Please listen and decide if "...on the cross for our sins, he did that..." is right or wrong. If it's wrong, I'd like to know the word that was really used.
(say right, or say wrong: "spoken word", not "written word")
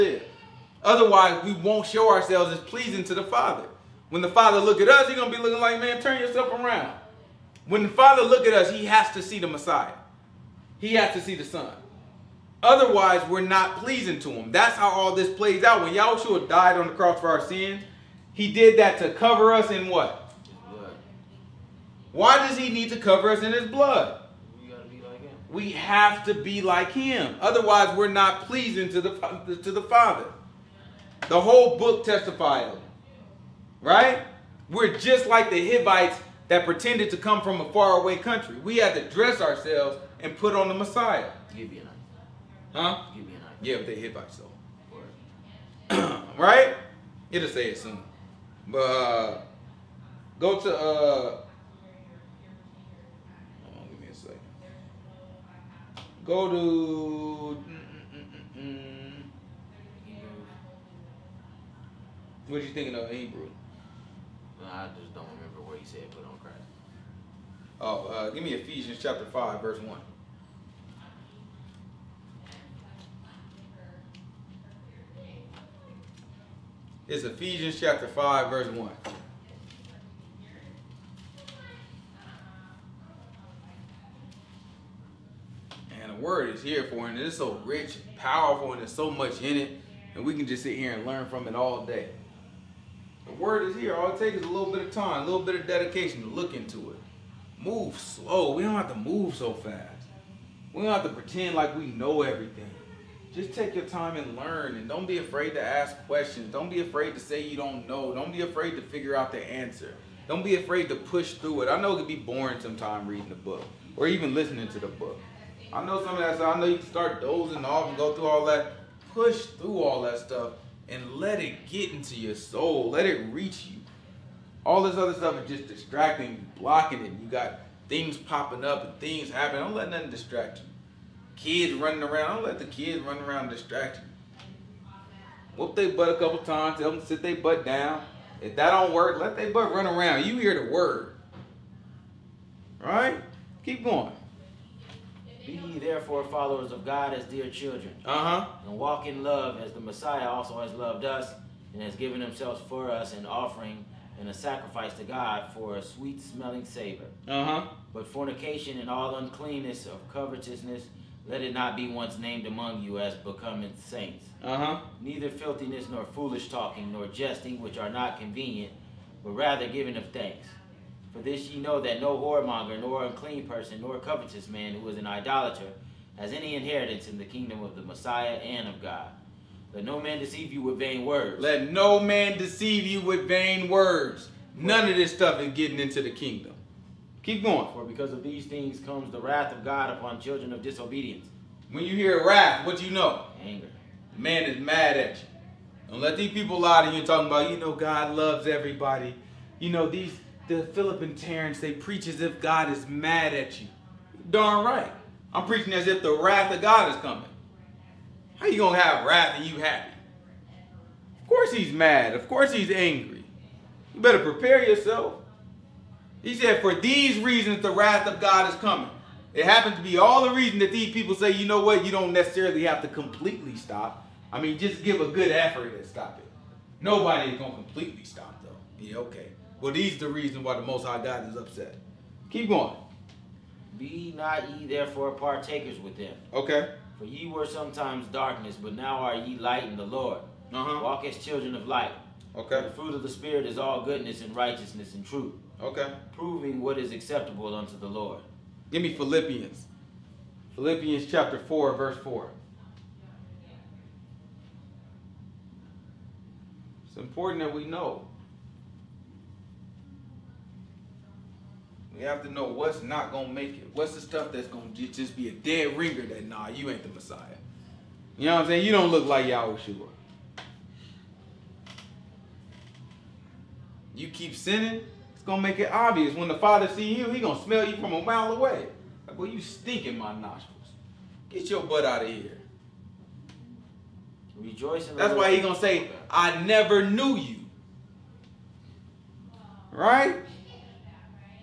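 right.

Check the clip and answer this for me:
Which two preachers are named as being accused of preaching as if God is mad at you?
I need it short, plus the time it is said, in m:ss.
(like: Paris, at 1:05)
Philip and Terrence, at 3:20.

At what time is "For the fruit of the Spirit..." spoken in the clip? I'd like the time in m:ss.
4:02.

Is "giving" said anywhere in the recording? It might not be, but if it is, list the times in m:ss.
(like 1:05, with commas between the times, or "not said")
2:49.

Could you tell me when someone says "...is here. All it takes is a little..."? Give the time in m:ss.
1:33.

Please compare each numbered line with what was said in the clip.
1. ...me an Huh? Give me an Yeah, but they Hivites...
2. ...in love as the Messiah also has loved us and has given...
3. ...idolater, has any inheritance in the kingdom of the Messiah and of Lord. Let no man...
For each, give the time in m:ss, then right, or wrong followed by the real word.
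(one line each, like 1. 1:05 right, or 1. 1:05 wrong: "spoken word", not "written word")
1. 0:41 right
2. 2:29 right
3. 2:55 wrong: "God", not "Lord".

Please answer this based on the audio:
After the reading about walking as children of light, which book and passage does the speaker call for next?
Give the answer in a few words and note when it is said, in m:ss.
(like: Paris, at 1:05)
Philippians 4:4, at 4:10.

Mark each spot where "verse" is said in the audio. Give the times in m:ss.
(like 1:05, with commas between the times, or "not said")
1:09, 1:18, 4:11.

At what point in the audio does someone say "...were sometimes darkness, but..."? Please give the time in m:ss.
3:57.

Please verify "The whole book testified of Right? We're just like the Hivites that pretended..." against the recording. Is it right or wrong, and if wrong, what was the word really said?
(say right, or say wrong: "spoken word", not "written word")
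right.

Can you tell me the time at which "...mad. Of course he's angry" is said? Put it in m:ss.
3:31.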